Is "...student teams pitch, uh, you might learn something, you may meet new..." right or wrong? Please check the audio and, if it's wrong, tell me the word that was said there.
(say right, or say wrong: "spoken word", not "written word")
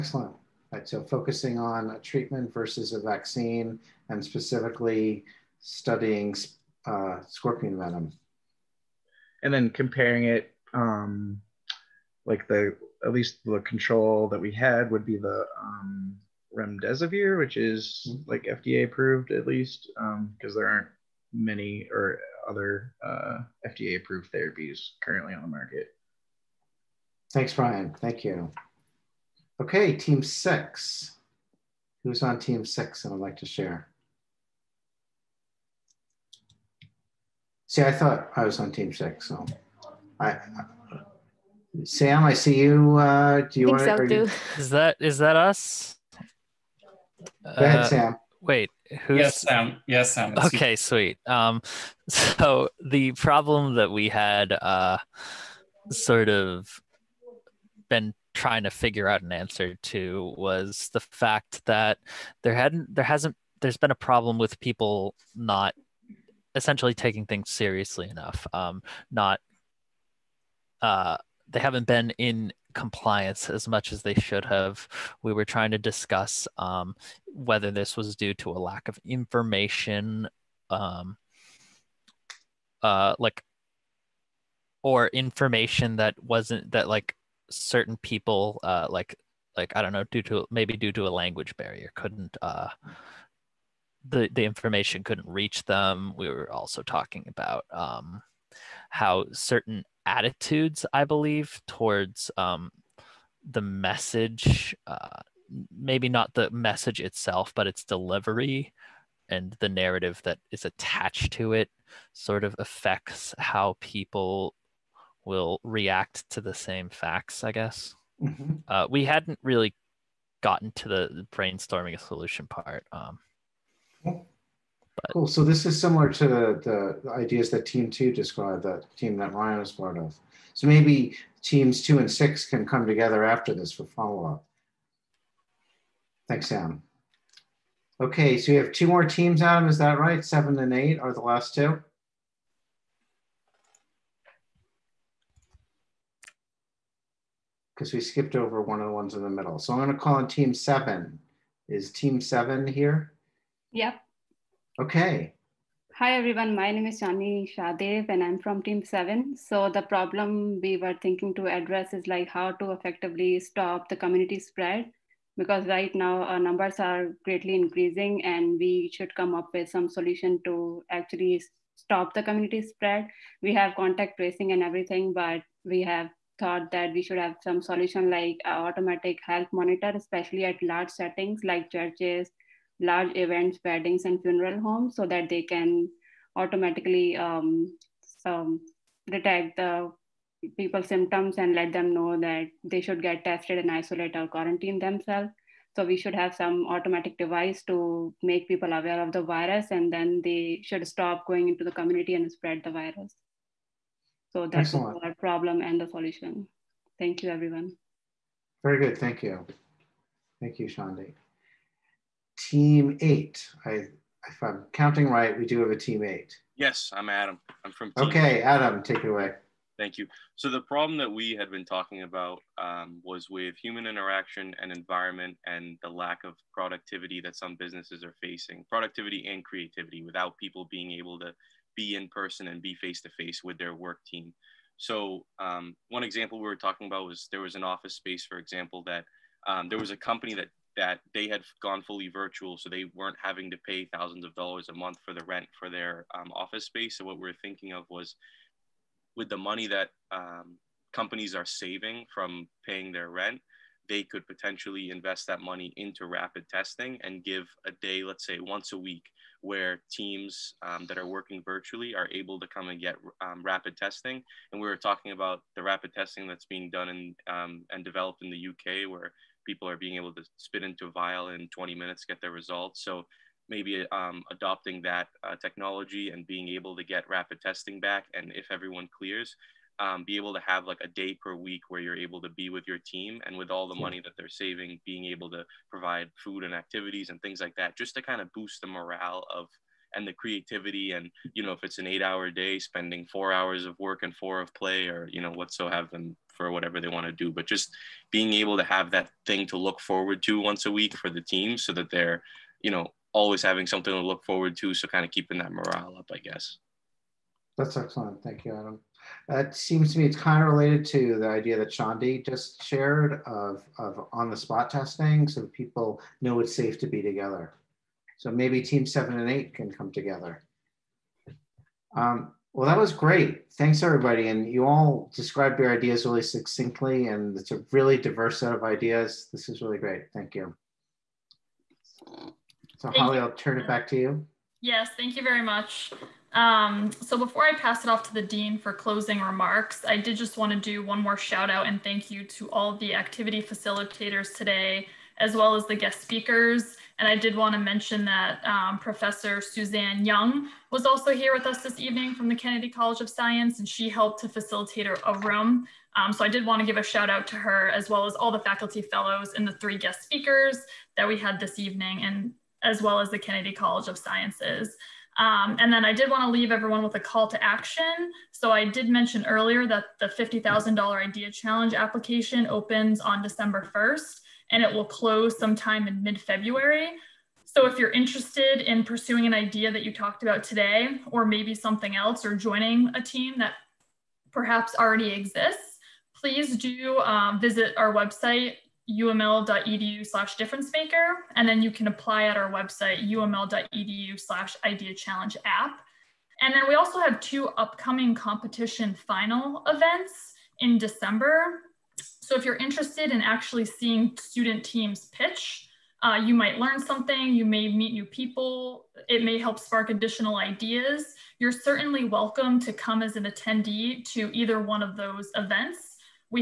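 right.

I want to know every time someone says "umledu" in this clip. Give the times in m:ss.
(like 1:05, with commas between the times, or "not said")
6:28, 6:33.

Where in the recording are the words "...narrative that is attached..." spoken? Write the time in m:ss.
1:49.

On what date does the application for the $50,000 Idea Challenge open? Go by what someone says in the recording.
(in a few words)
December 1st.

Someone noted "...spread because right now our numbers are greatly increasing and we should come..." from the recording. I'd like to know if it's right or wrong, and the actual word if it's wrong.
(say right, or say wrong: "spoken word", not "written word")
right.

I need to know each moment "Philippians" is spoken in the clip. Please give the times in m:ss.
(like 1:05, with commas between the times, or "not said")
not said.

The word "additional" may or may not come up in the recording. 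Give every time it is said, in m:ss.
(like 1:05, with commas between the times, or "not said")
6:49.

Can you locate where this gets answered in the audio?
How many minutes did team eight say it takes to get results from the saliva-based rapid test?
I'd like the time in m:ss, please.
4:31.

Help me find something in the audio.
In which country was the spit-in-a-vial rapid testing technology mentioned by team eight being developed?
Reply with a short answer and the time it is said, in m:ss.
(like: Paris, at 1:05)
the UK, at 4:28.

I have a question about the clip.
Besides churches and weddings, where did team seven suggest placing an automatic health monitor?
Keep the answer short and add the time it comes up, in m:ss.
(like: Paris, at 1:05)
funeral homes, at 3:04.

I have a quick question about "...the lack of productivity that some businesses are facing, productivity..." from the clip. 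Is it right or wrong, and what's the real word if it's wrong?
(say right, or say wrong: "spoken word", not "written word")
right.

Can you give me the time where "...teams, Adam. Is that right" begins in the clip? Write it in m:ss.
2:19.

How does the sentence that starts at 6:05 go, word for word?
Um, and then I did want to leave everyone with a call to action.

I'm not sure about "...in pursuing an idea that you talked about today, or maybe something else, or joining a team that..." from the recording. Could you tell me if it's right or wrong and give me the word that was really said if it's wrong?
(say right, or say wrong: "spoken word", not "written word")
right.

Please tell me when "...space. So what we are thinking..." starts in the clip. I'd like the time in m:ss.
4:06.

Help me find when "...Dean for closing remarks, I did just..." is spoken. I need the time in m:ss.
5:38.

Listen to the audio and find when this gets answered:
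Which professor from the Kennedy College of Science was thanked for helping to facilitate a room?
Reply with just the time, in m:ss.
5:49.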